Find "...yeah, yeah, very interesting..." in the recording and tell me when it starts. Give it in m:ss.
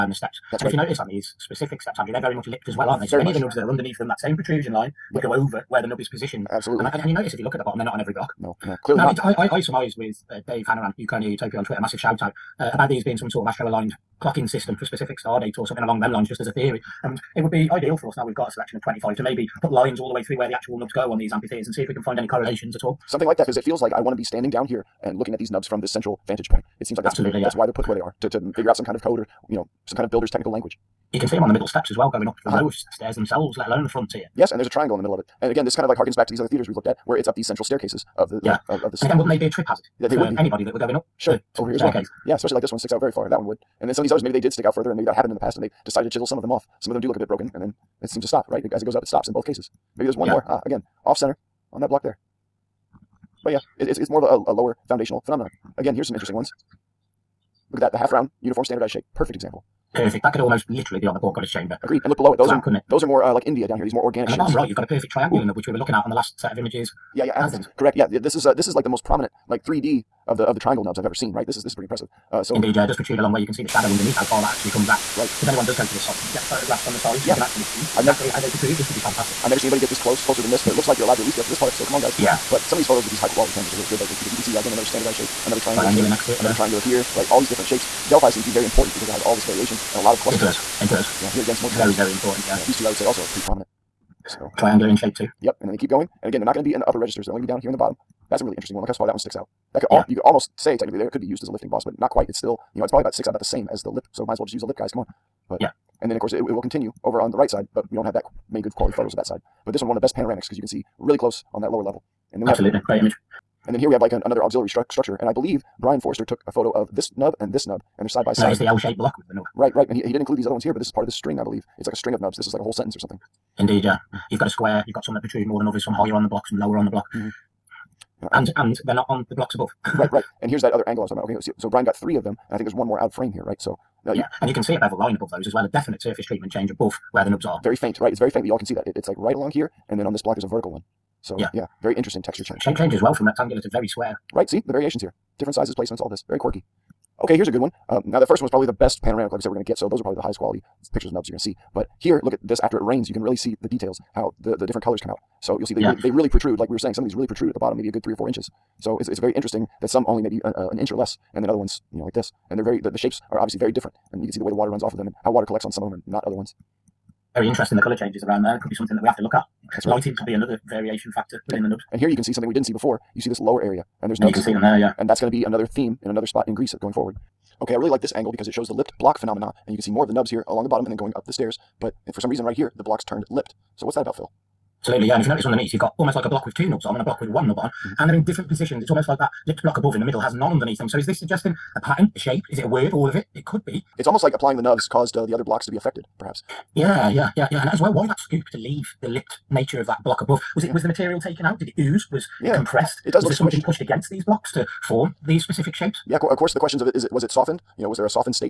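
2:21.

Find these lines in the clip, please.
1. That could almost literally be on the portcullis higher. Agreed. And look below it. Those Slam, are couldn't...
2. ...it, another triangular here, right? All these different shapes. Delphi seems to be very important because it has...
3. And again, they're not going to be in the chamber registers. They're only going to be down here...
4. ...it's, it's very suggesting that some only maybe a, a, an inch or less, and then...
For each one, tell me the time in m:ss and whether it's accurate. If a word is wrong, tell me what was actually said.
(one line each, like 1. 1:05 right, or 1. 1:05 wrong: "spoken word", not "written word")
1. 1:00 wrong: "chamber", not "higher"
2. 1:26 right
3. 1:36 wrong: "upper", not "chamber"
4. 2:38 wrong: "interesting", not "suggesting".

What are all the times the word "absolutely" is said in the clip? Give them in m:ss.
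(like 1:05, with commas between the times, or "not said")
0:06, 0:27, 1:52, 3:04.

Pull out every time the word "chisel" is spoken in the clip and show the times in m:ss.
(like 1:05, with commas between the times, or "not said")
0:46.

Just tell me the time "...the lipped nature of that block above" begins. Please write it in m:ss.
3:19.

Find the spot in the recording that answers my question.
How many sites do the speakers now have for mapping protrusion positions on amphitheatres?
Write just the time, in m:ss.
0:18.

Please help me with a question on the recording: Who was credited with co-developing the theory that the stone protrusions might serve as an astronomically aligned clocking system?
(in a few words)
Dave Hanoran.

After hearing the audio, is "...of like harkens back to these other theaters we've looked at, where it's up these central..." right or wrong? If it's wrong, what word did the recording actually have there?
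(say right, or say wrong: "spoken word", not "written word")
right.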